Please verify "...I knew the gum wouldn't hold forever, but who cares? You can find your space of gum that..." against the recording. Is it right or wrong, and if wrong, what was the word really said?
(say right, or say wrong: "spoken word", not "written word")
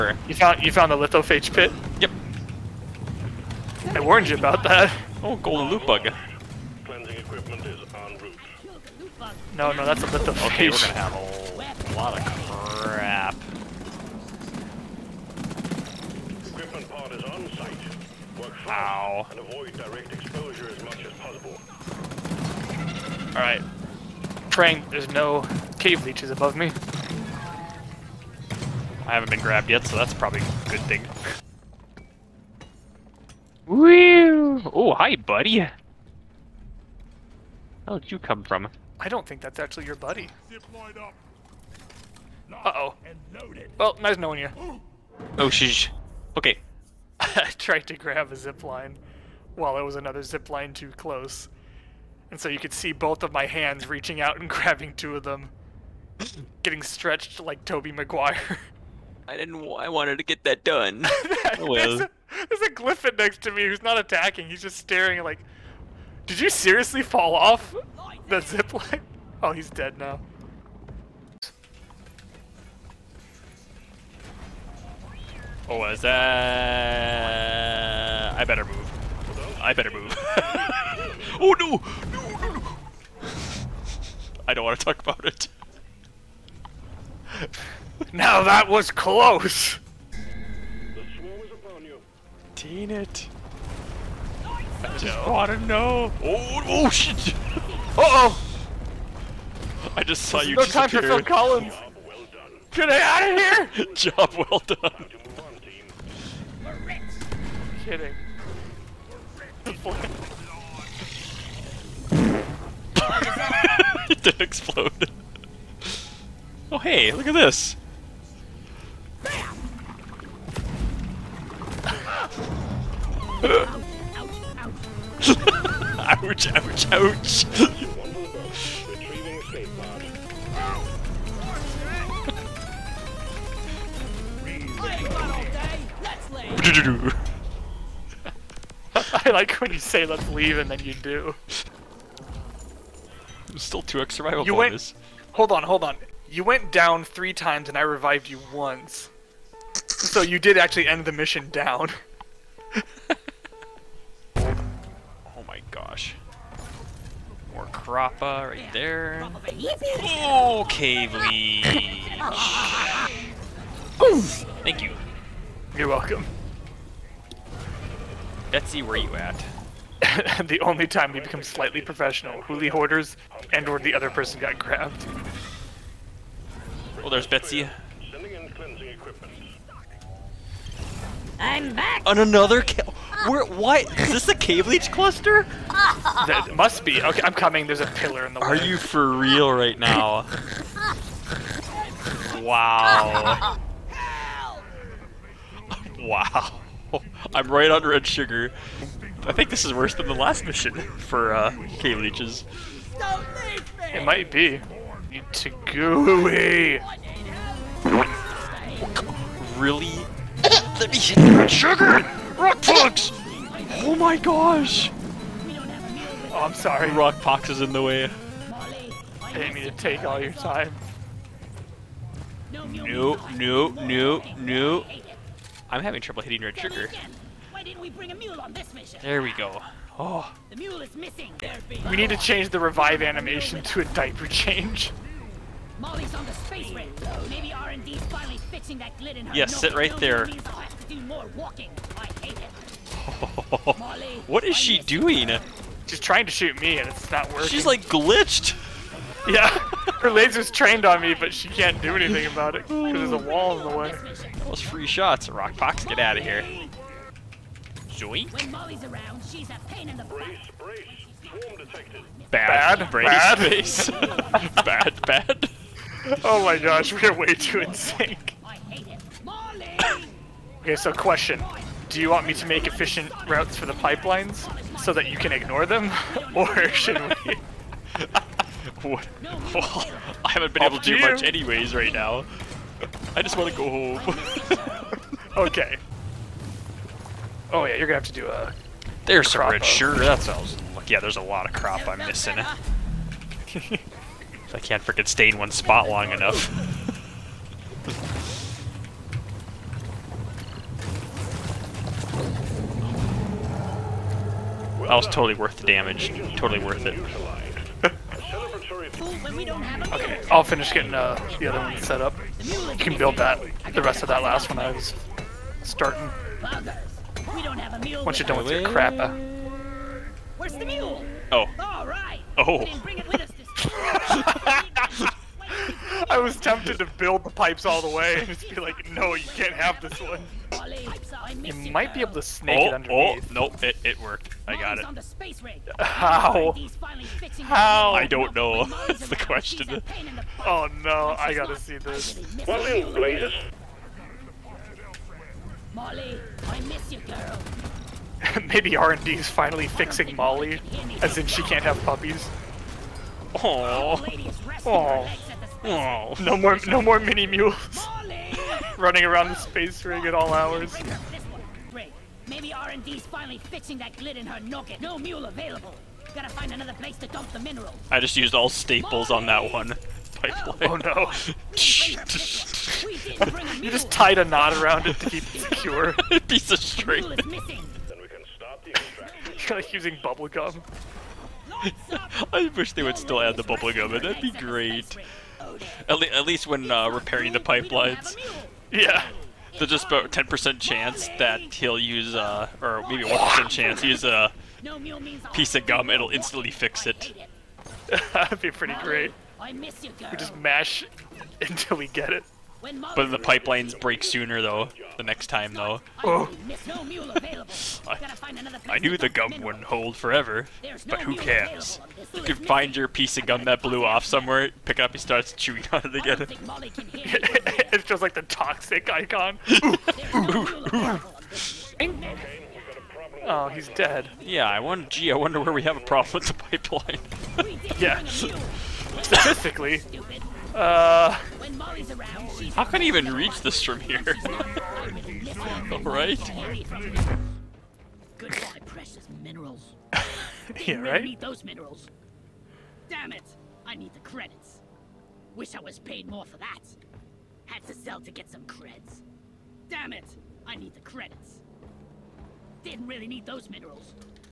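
wrong: "piece", not "space".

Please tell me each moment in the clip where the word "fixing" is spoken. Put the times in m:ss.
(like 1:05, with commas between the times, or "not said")
3:58, 5:49, 6:03.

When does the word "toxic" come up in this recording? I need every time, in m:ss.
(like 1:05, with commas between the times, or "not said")
6:58.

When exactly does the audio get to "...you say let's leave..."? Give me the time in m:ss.
2:19.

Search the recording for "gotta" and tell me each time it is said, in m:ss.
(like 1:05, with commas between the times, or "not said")
5:41, 6:06.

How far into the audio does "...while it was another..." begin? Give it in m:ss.
0:49.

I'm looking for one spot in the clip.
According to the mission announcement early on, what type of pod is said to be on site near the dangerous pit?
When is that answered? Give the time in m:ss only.
0:16.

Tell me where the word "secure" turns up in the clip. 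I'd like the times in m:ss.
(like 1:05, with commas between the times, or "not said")
6:15.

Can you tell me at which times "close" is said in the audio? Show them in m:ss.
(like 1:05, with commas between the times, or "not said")
0:50, 1:28.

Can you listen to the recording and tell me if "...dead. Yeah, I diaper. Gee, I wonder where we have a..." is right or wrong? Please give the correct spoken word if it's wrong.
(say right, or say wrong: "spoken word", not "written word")
wrong: "wonder", not "diaper".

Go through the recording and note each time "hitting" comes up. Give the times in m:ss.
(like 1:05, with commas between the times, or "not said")
3:46.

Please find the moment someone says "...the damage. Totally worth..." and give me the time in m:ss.
5:05.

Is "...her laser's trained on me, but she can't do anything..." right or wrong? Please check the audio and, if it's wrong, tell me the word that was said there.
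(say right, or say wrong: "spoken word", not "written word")
right.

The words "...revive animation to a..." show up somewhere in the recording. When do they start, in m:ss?
3:52.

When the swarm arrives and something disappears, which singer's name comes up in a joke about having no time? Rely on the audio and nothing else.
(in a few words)
Phil Collins.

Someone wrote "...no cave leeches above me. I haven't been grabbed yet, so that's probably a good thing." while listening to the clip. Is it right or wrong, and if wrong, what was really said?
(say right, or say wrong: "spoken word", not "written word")
right.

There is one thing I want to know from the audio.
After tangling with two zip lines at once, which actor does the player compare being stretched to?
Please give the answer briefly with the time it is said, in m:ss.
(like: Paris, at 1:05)
Tobey Maguire, at 0:57.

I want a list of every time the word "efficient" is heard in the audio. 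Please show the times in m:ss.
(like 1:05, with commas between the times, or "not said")
4:32.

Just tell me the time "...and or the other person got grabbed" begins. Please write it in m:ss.
2:53.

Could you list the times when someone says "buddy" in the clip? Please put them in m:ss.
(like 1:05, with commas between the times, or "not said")
0:35, 0:39.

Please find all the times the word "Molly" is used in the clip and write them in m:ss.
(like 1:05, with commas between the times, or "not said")
3:55, 5:45, 5:50.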